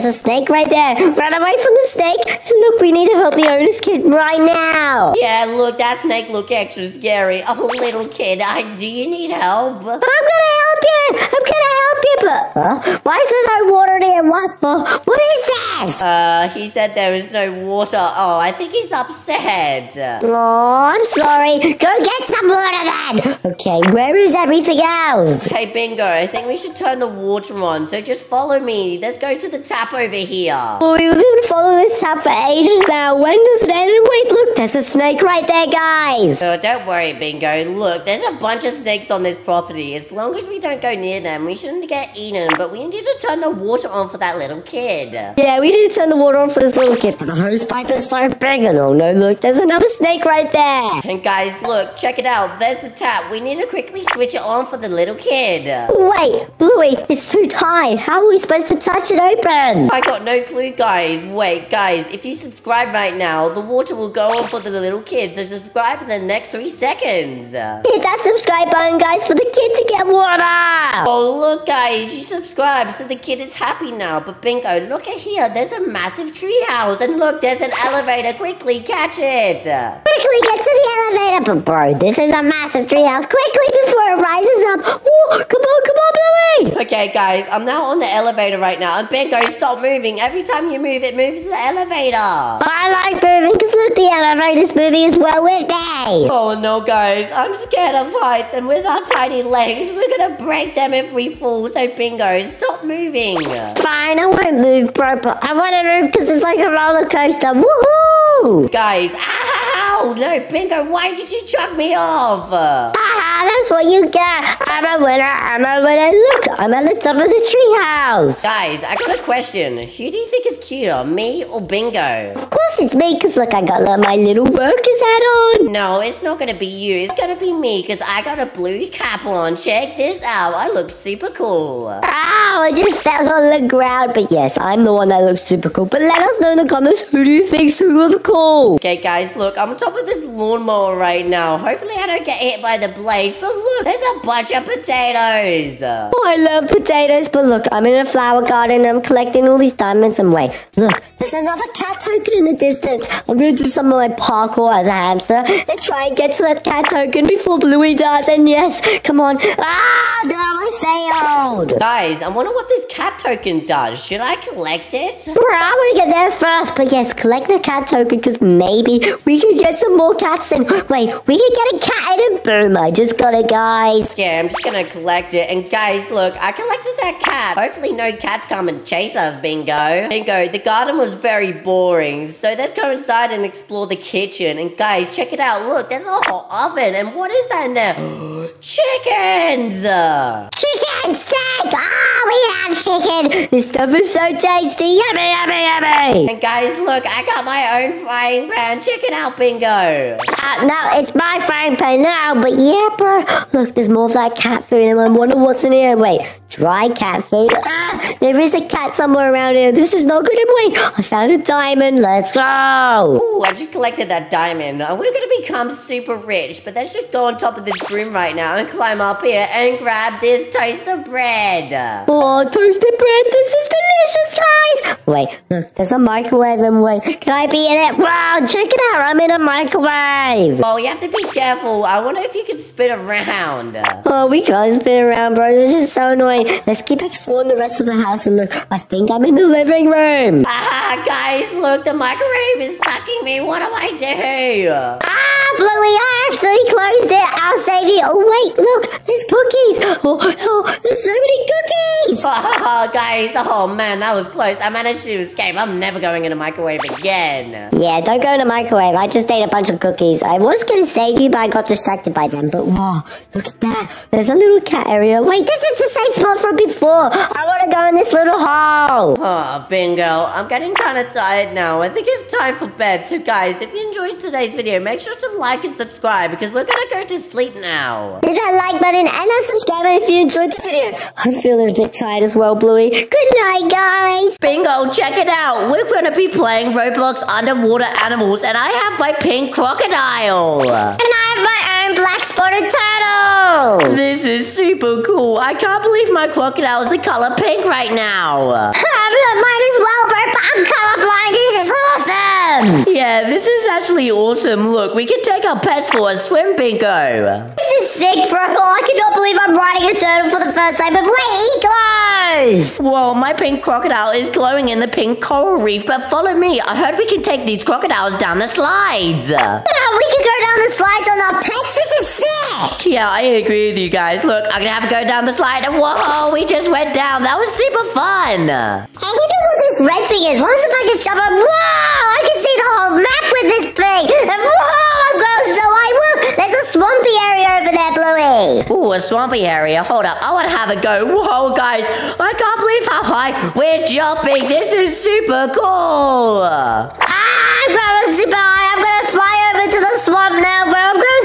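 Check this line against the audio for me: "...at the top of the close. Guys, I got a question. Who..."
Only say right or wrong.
wrong.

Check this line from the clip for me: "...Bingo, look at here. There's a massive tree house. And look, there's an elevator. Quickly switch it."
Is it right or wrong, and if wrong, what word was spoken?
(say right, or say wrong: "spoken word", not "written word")
wrong: "catch", not "switch".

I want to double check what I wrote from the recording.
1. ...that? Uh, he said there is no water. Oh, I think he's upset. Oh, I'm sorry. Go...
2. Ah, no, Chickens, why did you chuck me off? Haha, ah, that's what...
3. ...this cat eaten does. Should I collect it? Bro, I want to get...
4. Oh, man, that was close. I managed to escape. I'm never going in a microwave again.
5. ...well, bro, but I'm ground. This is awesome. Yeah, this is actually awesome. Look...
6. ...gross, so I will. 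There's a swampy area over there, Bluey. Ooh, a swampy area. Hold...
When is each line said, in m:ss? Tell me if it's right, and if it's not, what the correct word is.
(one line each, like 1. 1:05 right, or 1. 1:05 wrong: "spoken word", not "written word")
1. 0:15 right
2. 1:49 wrong: "Bingo", not "Chickens"
3. 2:42 wrong: "token", not "eaten"
4. 4:13 right
5. 4:59 wrong: "colorblind", not "ground"
6. 5:35 right.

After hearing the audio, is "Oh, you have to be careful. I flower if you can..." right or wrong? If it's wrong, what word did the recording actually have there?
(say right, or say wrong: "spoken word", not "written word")
wrong: "wonder", not "flower".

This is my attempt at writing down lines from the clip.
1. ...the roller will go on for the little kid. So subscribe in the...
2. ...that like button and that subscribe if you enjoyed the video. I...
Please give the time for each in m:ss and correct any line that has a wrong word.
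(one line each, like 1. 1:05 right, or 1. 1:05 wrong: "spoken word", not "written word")
1. 1:03 wrong: "water", not "roller"
2. 4:38 right.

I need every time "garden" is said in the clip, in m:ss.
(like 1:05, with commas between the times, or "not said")
2:28, 3:00.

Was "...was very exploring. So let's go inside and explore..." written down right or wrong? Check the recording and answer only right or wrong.
wrong.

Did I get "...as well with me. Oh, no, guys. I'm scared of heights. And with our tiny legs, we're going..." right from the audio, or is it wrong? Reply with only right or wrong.
right.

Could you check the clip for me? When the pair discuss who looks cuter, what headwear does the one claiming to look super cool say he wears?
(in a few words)
blue cap.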